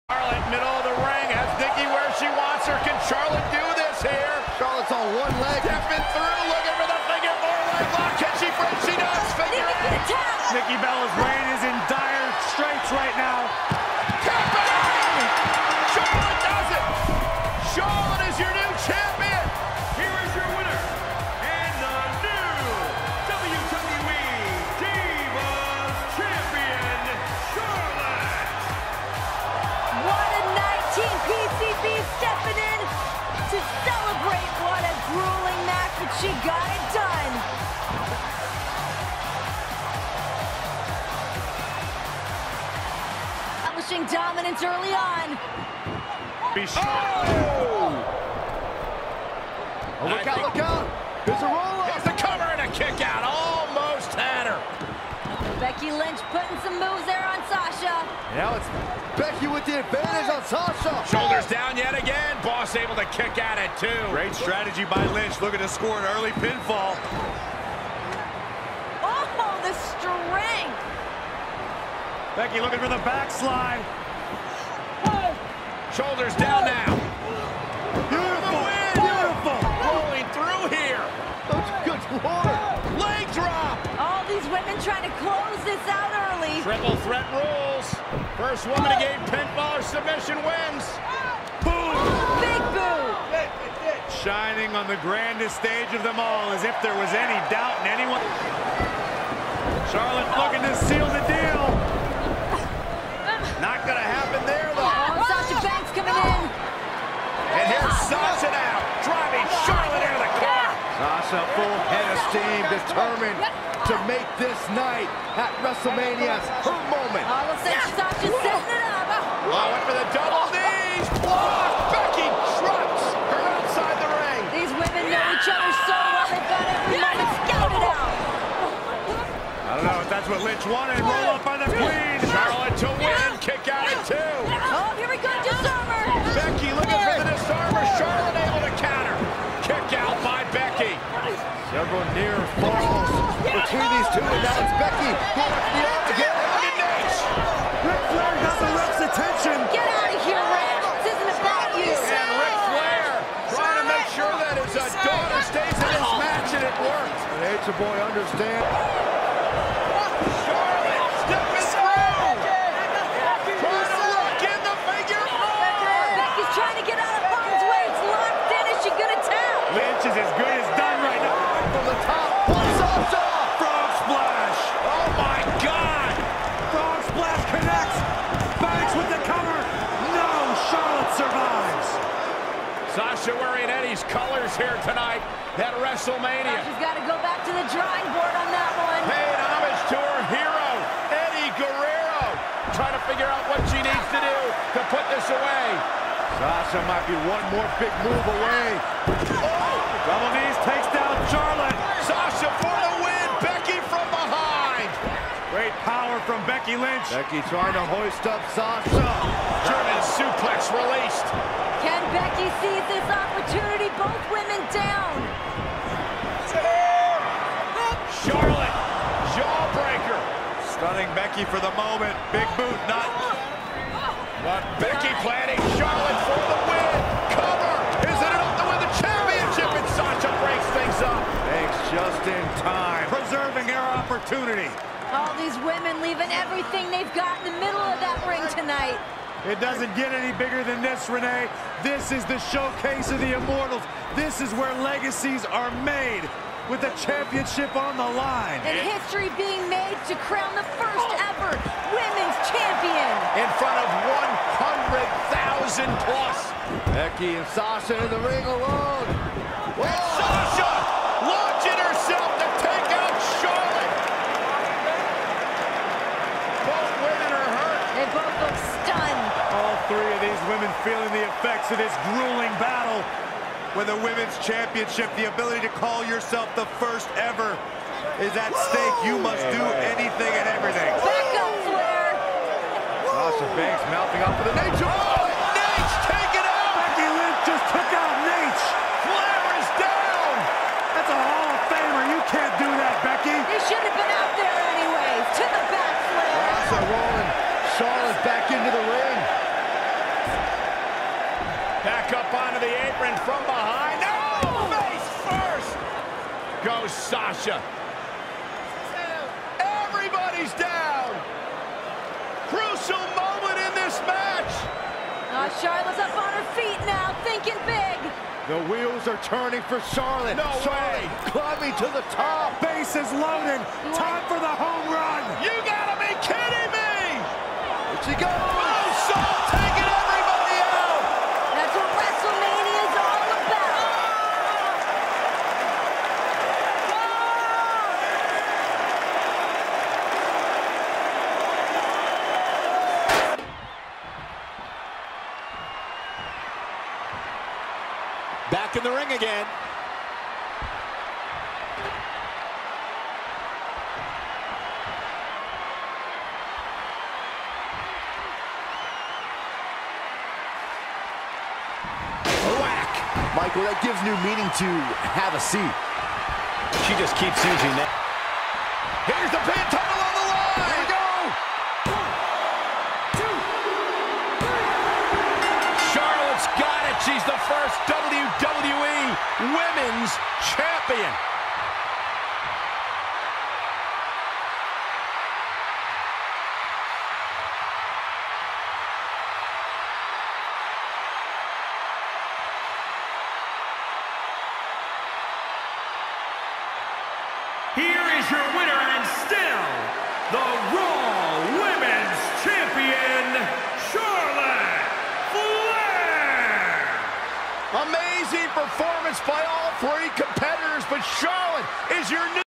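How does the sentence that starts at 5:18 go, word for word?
The wheels are turning for Charlotte.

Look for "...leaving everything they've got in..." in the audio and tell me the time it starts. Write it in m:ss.
3:56.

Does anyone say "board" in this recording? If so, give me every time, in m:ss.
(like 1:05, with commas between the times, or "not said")
3:08.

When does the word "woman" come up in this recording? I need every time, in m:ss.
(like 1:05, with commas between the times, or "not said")
1:28.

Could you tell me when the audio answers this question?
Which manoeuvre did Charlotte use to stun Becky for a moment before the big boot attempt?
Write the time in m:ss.
3:39.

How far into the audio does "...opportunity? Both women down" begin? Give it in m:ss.
3:33.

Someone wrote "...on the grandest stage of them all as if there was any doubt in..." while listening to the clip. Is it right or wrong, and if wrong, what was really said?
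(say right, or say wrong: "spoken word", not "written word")
right.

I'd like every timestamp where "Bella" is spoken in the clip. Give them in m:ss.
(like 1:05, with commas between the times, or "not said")
0:10.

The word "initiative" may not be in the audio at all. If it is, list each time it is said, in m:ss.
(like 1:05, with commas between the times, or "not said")
not said.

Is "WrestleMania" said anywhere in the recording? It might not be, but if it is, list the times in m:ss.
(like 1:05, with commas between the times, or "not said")
1:55, 3:05.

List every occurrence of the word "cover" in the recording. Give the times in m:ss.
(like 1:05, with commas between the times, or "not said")
0:52, 3:47.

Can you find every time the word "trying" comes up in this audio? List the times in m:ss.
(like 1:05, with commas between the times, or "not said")
1:24, 2:33, 3:12, 3:27.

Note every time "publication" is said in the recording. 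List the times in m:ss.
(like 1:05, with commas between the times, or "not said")
not said.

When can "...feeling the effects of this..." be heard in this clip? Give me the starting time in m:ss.
4:30.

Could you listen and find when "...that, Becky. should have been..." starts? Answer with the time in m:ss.
4:52.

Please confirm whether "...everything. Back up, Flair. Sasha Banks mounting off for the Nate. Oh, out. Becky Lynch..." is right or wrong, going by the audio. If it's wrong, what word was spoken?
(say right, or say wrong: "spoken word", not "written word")
right.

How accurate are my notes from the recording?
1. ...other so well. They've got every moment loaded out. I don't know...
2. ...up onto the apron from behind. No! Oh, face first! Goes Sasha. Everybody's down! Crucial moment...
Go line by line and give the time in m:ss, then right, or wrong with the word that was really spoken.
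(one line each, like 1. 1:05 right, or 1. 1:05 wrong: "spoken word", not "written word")
1. 2:05 wrong: "scouted", not "loaded"
2. 5:02 right.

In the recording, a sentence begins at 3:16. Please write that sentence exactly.
Sasha might be one more big move away.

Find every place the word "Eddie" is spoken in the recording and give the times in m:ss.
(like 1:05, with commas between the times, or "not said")
3:03, 3:11.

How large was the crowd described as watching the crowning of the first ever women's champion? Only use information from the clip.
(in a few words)
100,000 plus.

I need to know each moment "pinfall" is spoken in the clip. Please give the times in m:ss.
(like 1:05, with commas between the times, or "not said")
1:06, 1:29.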